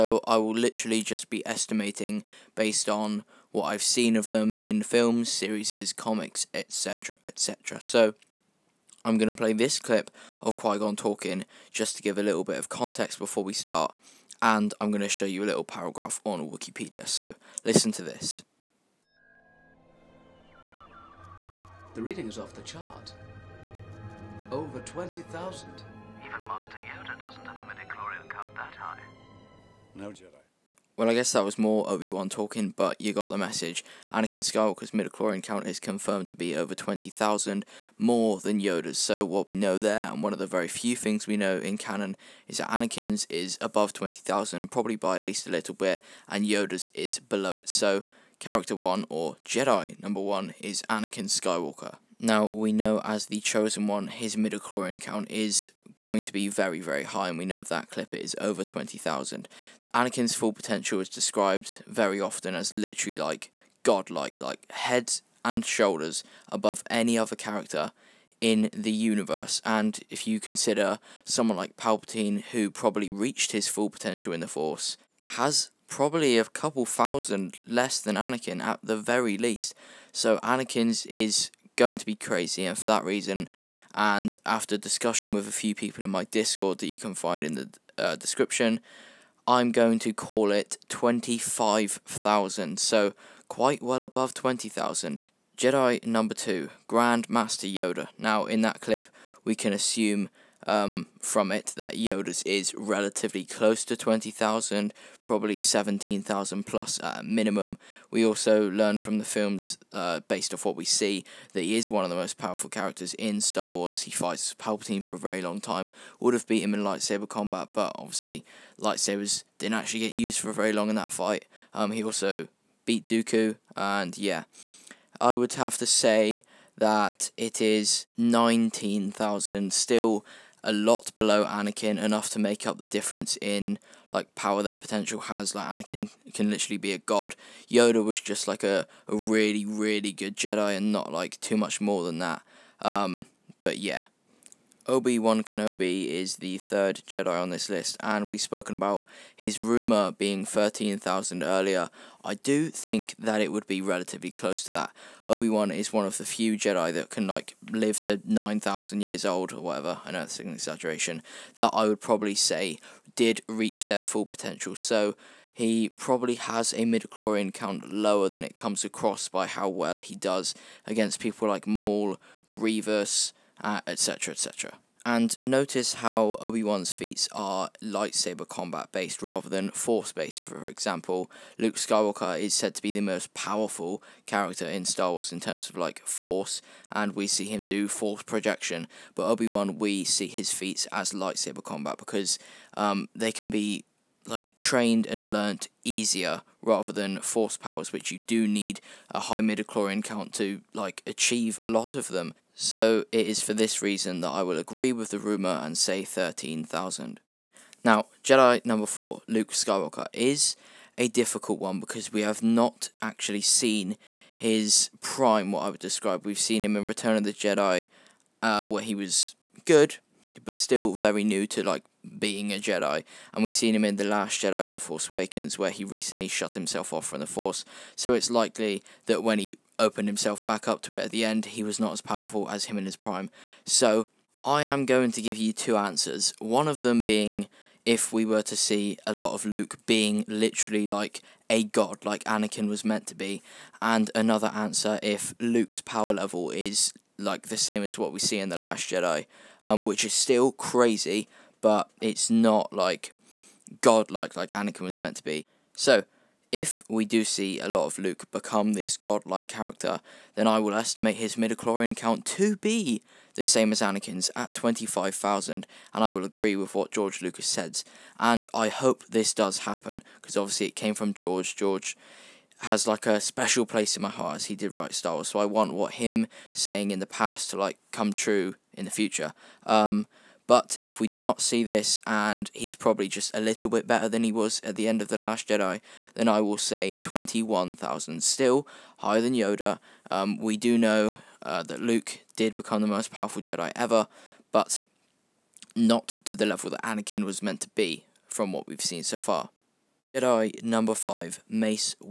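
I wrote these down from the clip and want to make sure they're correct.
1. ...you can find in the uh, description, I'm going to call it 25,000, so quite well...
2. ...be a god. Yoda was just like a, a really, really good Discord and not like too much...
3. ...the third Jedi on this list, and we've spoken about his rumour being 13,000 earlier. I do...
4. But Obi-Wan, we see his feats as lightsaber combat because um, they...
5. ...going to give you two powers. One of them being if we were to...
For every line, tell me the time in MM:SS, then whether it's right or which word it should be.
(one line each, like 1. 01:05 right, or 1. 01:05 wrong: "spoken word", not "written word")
1. 01:26 right
2. 02:16 wrong: "Jedi", not "Discord"
3. 02:26 right
4. 03:09 right
5. 03:54 wrong: "answers", not "powers".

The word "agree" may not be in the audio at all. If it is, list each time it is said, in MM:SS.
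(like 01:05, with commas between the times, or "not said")
03:24, 04:26.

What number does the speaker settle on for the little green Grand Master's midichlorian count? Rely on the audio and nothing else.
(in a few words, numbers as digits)
19,000.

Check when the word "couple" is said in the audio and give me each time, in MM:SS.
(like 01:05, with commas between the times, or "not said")
01:16.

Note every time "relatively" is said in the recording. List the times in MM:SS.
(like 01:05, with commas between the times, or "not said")
01:42, 02:33.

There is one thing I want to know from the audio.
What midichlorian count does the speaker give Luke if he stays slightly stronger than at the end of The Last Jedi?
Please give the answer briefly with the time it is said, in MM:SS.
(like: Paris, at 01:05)
21,000, at 04:46.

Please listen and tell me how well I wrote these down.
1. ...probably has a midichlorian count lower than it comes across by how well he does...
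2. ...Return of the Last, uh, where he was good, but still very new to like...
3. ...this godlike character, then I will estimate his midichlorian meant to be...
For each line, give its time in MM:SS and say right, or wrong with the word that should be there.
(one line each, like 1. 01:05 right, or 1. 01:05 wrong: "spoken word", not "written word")
1. 02:45 right
2. 03:36 wrong: "Jedi", not "Last"
3. 04:18 wrong: "count", not "meant".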